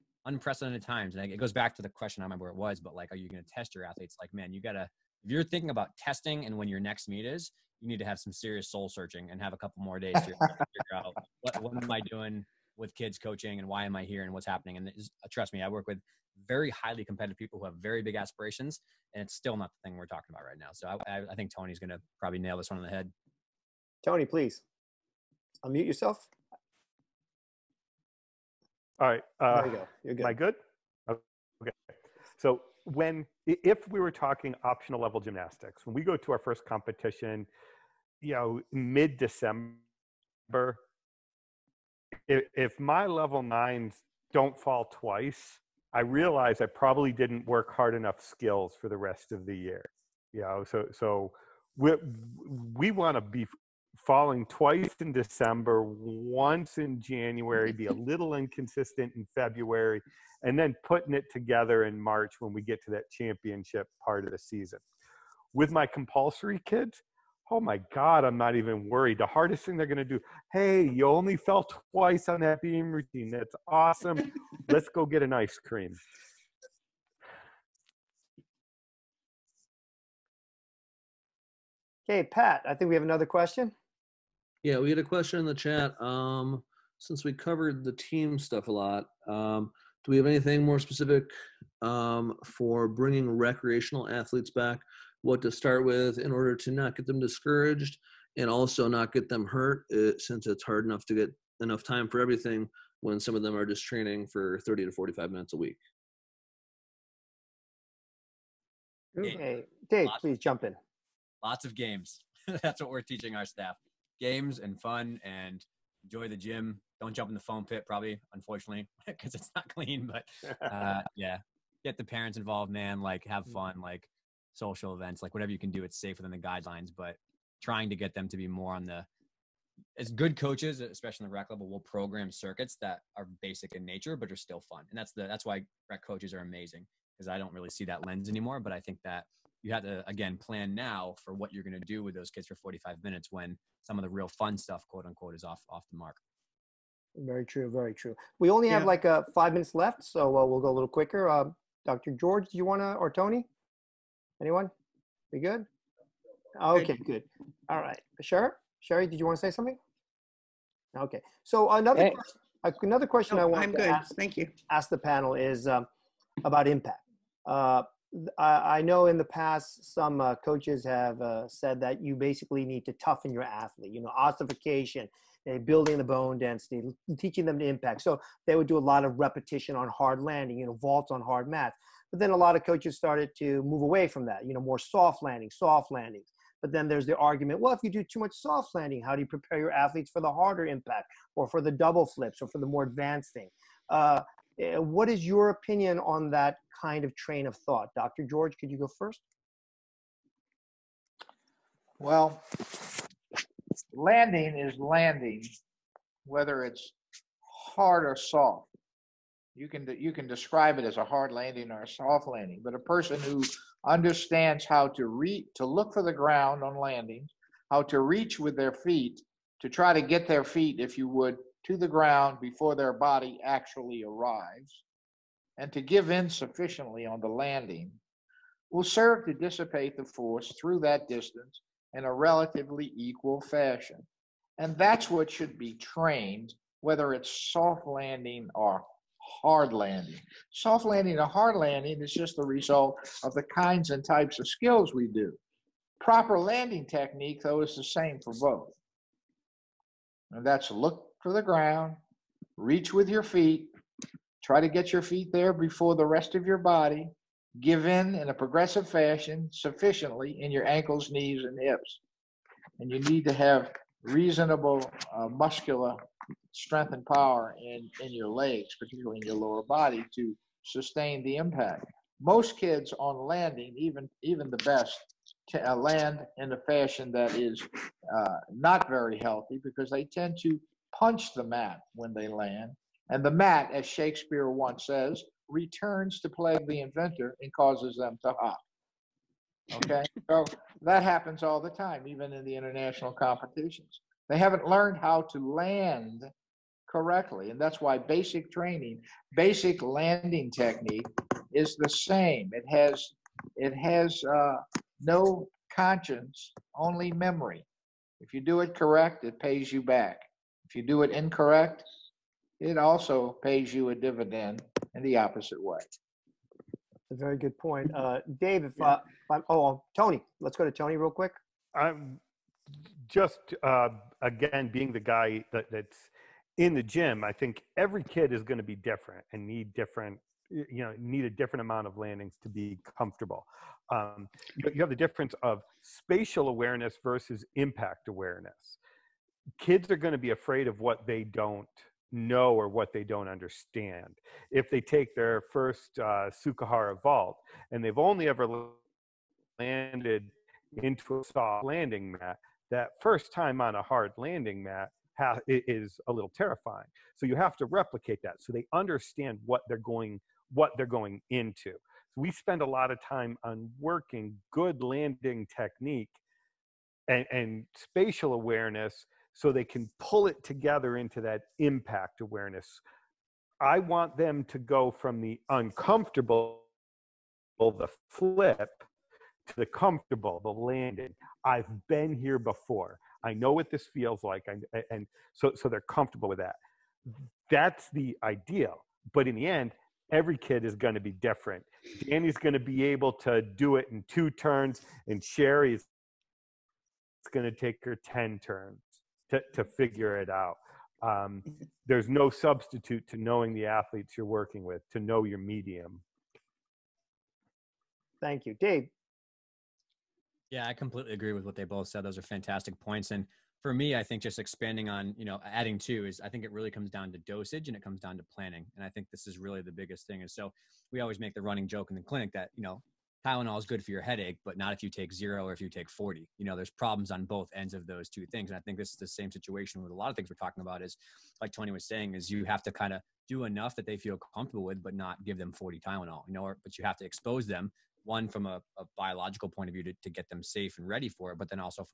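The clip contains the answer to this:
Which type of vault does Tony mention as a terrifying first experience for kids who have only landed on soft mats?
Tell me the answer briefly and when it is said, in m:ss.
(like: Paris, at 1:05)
Tsukahara, at 5:46.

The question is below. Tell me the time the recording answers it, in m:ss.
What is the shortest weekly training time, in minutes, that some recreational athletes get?
1:44.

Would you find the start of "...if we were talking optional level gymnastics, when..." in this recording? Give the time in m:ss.
0:33.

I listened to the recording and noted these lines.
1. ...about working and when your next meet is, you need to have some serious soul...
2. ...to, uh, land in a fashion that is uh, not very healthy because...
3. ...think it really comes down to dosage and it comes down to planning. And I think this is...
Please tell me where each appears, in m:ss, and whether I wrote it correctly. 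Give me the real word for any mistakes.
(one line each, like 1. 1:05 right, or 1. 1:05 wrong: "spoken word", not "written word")
1. 0:05 wrong: "testing", not "working"
2. 4:35 right
3. 6:56 right.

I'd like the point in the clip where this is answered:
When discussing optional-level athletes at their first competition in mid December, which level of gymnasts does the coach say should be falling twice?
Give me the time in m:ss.
0:43.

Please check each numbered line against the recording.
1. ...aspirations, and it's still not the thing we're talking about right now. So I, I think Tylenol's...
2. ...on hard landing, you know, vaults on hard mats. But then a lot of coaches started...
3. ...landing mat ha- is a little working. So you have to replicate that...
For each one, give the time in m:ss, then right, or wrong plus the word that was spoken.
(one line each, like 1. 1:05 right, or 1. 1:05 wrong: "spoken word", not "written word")
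1. 0:18 wrong: "Tony", not "Tylenol"
2. 2:59 right
3. 5:54 wrong: "terrifying", not "working".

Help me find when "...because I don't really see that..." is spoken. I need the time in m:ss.
2:17.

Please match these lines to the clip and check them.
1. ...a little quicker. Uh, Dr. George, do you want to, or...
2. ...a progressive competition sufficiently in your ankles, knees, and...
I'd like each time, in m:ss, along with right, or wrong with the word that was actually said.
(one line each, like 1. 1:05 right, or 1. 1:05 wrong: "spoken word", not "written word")
1. 2:30 right
2. 4:18 wrong: "fashion", not "competition".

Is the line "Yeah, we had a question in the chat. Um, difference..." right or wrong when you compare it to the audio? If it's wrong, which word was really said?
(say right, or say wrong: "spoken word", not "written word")
wrong: "since", not "difference".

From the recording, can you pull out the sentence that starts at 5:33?
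Um, you have the difference of spatial awareness versus impact awareness.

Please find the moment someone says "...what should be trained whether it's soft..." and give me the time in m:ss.
3:55.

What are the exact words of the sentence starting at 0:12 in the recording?
with kids coaching and why am I here and what's happening.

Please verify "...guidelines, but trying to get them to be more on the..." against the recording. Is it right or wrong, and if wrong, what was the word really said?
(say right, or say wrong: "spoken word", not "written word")
right.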